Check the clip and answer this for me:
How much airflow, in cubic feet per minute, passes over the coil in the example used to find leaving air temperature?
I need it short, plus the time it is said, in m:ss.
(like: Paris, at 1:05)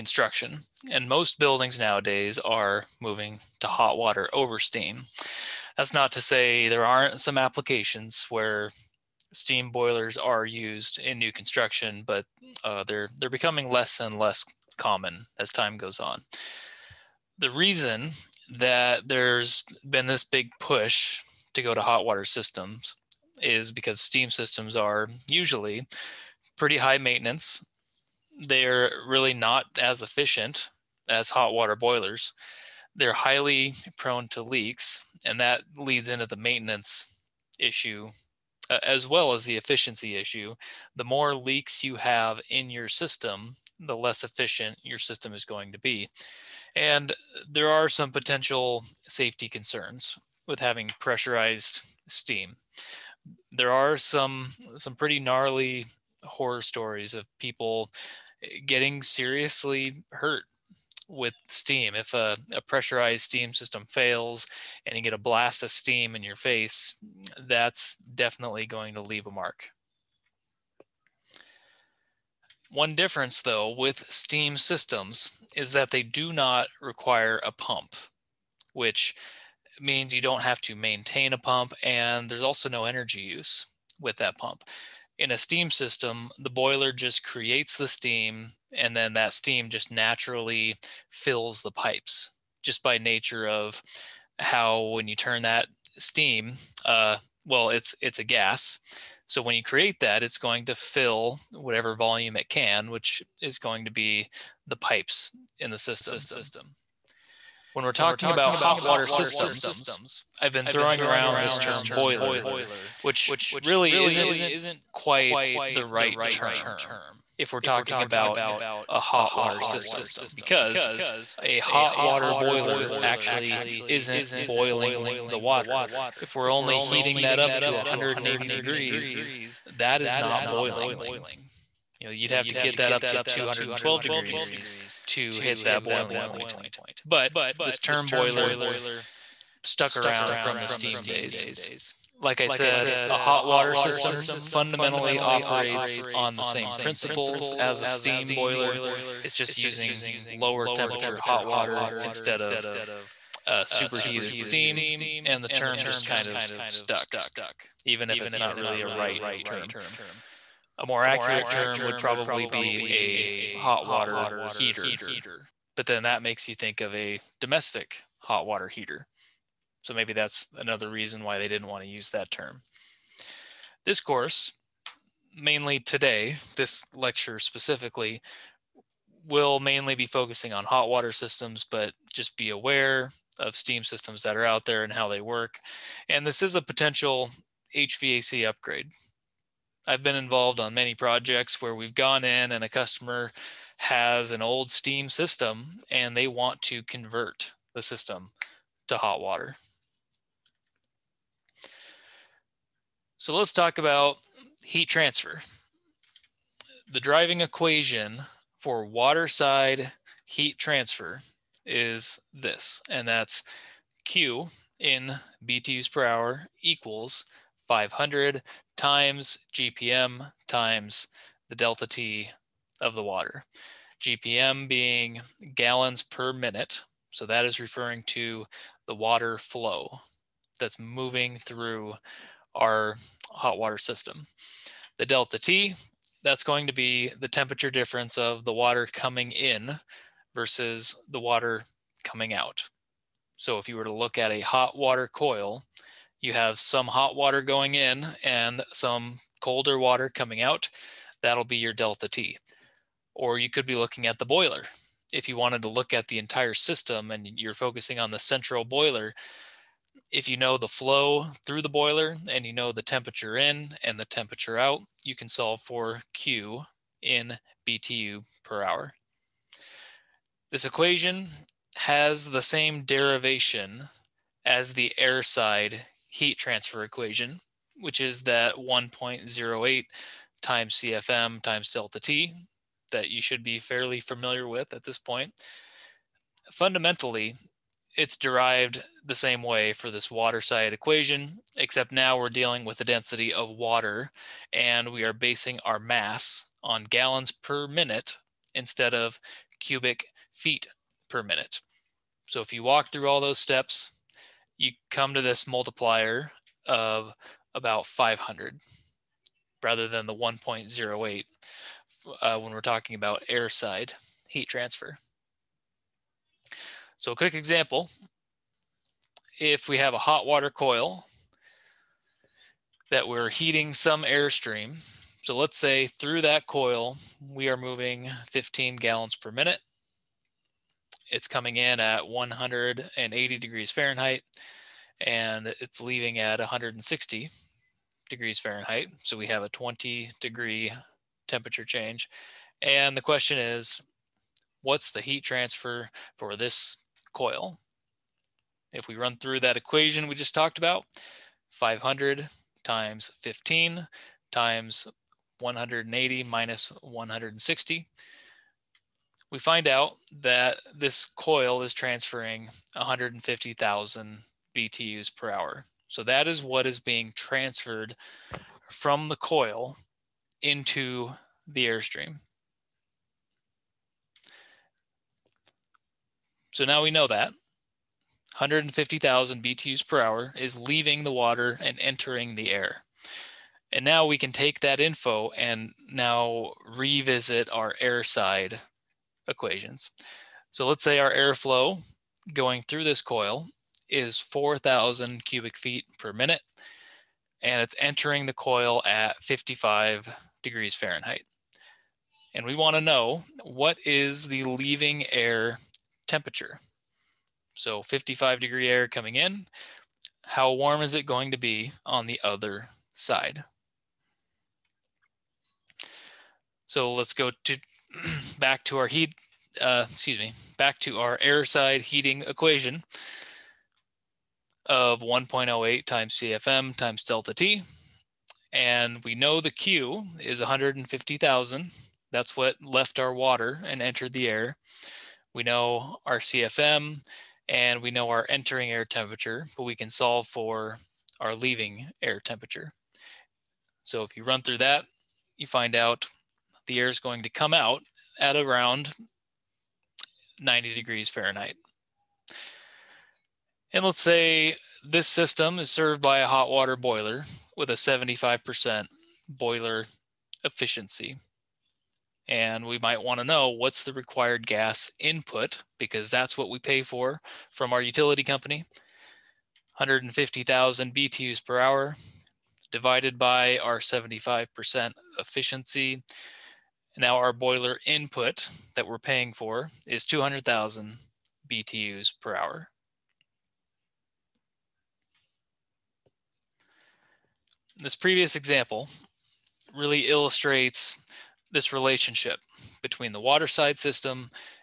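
4,000, at 6:34.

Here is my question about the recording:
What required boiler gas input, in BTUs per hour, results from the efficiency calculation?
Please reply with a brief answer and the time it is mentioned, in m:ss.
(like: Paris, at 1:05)
200,000 BTUs per hour, at 8:00.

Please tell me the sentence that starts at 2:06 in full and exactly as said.
If we're only heating that up to 180 degrees, that is not boiling.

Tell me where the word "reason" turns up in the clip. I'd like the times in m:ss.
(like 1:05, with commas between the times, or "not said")
0:17, 2:50.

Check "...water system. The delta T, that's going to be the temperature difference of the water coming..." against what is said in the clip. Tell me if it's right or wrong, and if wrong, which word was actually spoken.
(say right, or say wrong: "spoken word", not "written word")
right.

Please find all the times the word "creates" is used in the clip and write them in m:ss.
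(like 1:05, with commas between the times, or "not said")
1:27, 1:39.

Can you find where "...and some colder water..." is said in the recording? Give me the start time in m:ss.
4:08.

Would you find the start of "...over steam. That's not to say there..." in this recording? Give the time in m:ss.
0:04.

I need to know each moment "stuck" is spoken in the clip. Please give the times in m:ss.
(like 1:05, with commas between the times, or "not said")
2:19, 2:36.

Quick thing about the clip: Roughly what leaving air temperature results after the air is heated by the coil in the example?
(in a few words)
90 degrees Fahrenheit.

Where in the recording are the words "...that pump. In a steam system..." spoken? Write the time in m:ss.
1:24.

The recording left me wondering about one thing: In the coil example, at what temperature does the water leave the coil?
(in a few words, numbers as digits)
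160 degrees Fahrenheit.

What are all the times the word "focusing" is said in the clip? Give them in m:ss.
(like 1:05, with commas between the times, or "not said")
3:00, 4:17.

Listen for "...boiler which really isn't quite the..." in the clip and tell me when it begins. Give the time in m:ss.
1:51.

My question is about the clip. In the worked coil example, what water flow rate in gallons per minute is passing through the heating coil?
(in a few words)
15.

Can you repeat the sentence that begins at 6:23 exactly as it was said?
And now we can take that info and now revisit our air side equations.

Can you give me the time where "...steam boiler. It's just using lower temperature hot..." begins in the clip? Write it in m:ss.
2:27.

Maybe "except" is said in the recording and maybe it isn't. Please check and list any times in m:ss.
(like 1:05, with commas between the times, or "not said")
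4:51.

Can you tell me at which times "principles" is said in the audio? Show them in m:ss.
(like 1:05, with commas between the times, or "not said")
2:26.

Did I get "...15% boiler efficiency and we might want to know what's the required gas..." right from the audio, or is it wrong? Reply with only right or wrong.
wrong.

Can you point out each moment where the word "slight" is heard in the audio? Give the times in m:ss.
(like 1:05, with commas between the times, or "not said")
not said.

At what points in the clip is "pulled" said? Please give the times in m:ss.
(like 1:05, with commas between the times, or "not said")
not said.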